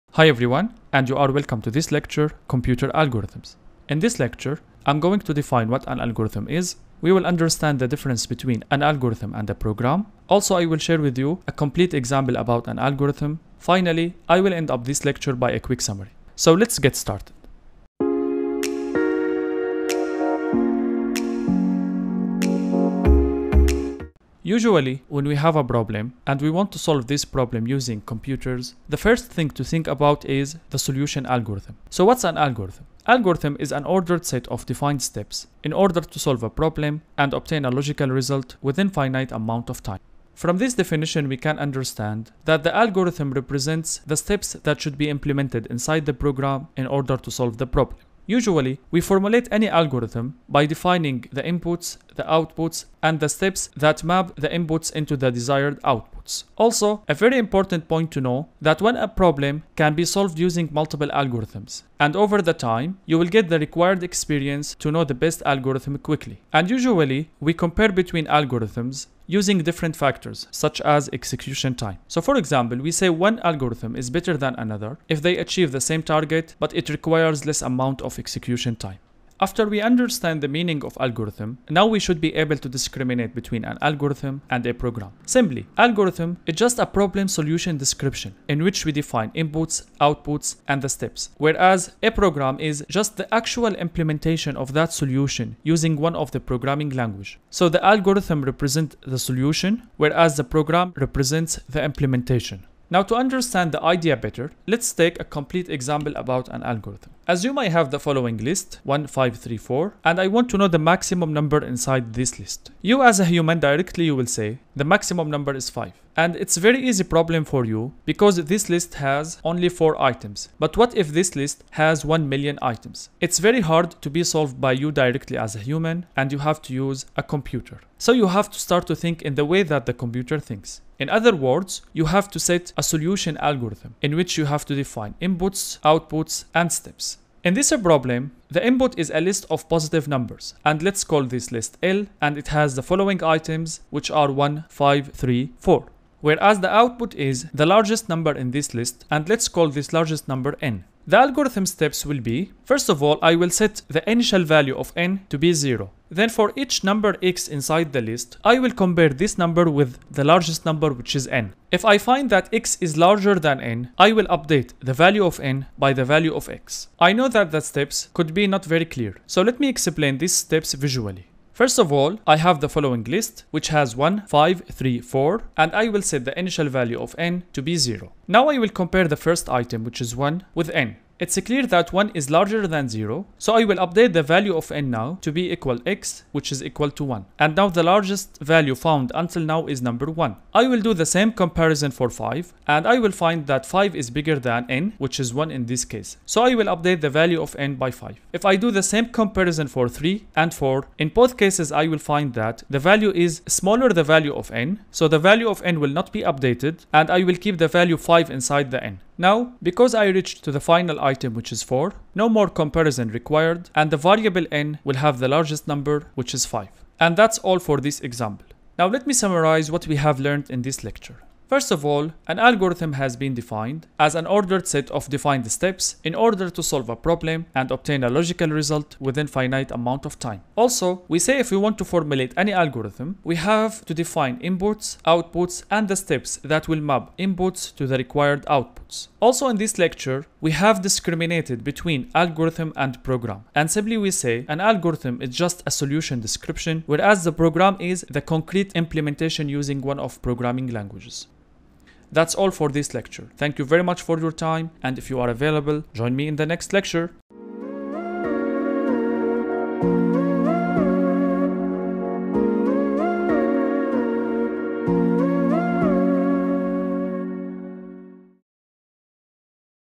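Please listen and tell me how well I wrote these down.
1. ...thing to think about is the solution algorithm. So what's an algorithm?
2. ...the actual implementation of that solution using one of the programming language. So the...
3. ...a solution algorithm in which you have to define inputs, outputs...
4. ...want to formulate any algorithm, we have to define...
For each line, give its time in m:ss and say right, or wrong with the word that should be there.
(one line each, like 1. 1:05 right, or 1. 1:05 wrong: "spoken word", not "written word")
1. 0:29 right
2. 1:33 right
3. 2:12 right
4. 3:51 right.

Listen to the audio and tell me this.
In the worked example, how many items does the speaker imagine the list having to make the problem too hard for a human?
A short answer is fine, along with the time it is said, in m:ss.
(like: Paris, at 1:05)
1 million, at 2:02.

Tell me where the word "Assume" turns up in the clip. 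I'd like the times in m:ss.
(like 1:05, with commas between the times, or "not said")
1:47.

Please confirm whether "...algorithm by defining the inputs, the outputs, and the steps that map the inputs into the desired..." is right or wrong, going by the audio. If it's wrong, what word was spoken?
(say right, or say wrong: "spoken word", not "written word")
right.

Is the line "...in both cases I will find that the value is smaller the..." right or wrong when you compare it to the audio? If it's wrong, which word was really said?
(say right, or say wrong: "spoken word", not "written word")
right.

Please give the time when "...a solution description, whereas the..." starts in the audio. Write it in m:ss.
4:05.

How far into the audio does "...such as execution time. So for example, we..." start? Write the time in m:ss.
1:10.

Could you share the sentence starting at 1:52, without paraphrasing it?
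You as a human directly you will say, the maximum number is 5.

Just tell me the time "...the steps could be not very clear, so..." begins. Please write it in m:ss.
2:47.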